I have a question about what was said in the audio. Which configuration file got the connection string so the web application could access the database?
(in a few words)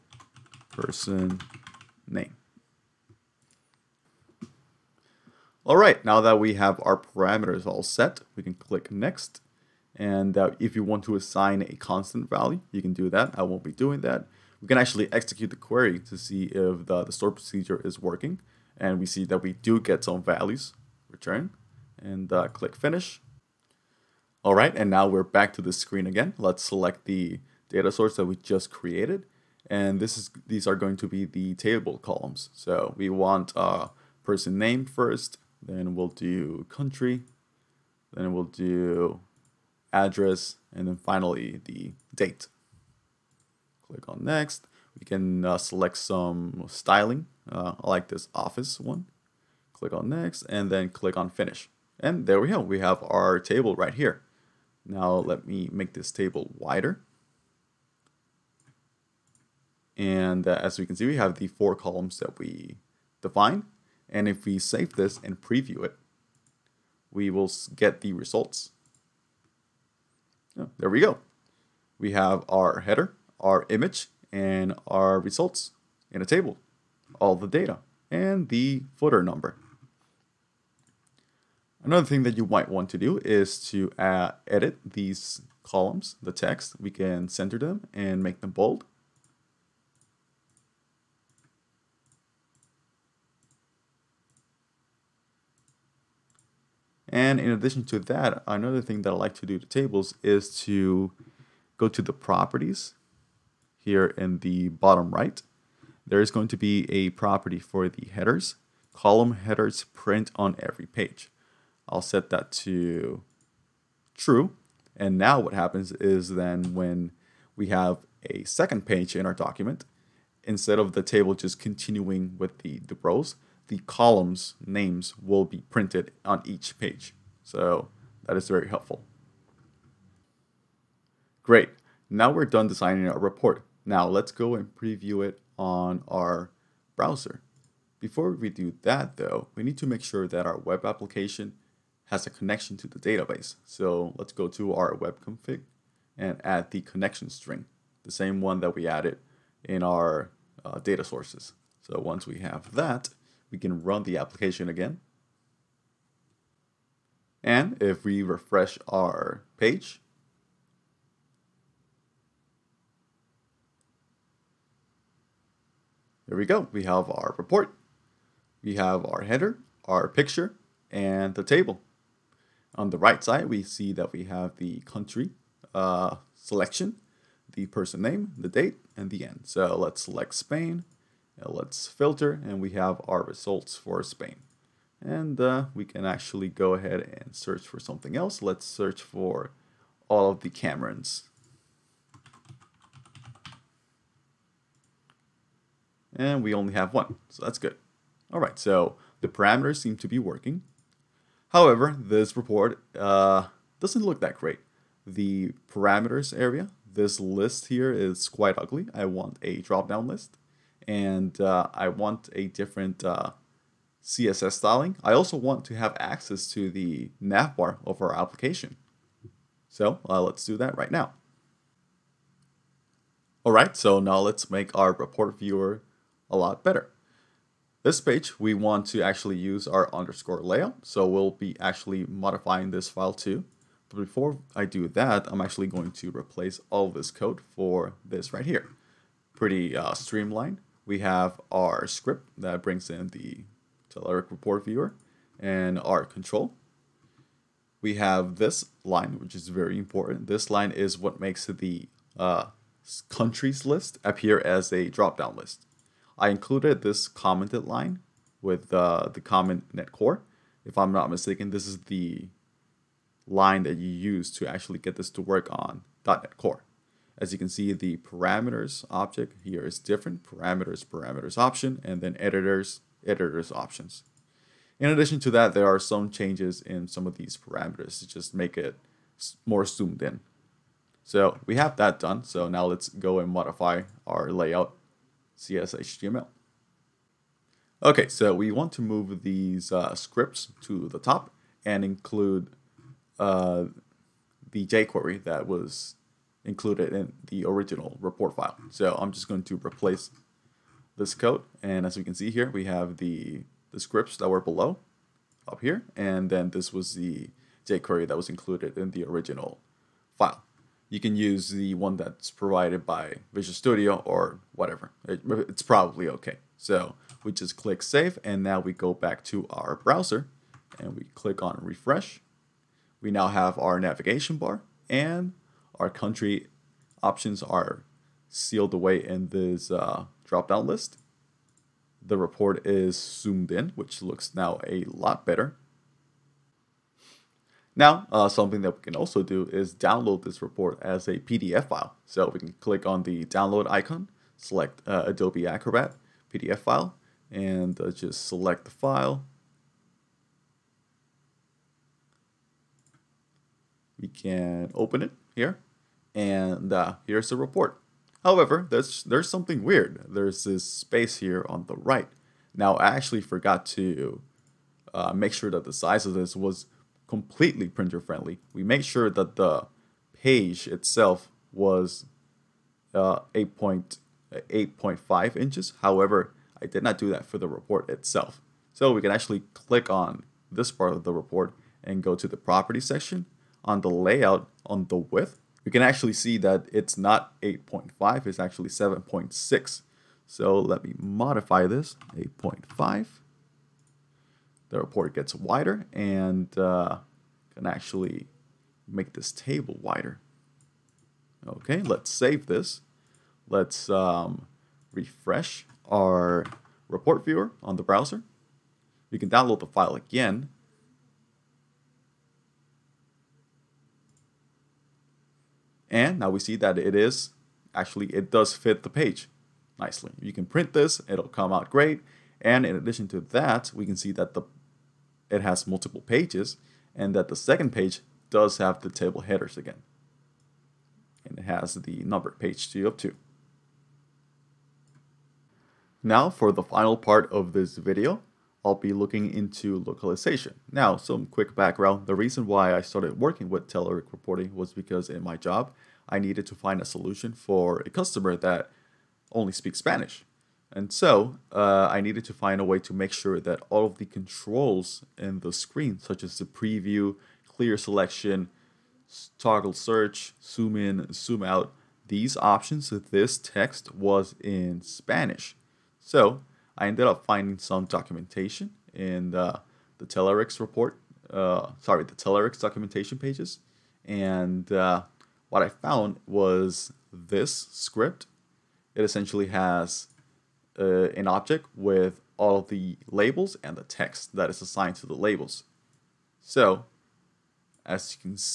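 web config.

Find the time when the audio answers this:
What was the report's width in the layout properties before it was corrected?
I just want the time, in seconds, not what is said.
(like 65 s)
388 s.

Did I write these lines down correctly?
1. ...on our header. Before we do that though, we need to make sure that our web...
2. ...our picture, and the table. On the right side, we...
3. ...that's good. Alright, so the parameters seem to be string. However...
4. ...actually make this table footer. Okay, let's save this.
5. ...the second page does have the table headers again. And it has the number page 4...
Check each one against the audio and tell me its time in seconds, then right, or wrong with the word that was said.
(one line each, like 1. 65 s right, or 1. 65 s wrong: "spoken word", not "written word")
1. 135 s wrong: "browser", not "header"
2. 169 s right
3. 197 s wrong: "working", not "string"
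4. 397 s wrong: "wider", not "footer"
5. 427 s wrong: "2", not "4".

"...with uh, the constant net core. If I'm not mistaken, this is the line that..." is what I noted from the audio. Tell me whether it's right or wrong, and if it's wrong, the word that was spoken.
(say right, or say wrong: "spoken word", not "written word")
wrong: "comment", not "constant".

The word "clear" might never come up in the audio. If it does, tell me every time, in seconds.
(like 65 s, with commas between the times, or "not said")
457 s.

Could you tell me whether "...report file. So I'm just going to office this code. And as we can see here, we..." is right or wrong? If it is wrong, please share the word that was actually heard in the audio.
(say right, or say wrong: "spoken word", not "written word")
wrong: "replace", not "office".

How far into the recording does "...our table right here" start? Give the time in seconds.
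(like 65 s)
53 s.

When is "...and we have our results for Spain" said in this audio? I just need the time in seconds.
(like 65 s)
182 s.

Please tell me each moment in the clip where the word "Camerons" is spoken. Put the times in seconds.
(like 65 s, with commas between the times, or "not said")
190 s.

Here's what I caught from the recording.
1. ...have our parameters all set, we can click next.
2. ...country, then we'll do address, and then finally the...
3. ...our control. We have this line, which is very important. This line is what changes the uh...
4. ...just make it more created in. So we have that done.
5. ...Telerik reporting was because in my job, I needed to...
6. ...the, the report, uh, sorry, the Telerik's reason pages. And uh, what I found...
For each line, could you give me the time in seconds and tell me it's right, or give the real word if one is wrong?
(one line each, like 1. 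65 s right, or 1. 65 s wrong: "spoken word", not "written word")
1. 6 s right
2. 36 s right
3. 245 s wrong: "makes", not "changes"
4. 278 s wrong: "zoomed", not "created"
5. 443 s right
6. 469 s wrong: "documentation", not "reason".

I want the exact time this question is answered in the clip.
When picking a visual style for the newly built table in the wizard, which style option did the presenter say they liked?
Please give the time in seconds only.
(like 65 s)
48 s.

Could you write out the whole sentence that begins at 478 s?
It essentially has uh, an object with all the labels and the text that is assigned to the labels.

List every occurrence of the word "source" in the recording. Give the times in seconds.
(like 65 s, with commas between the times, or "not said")
27 s, 151 s.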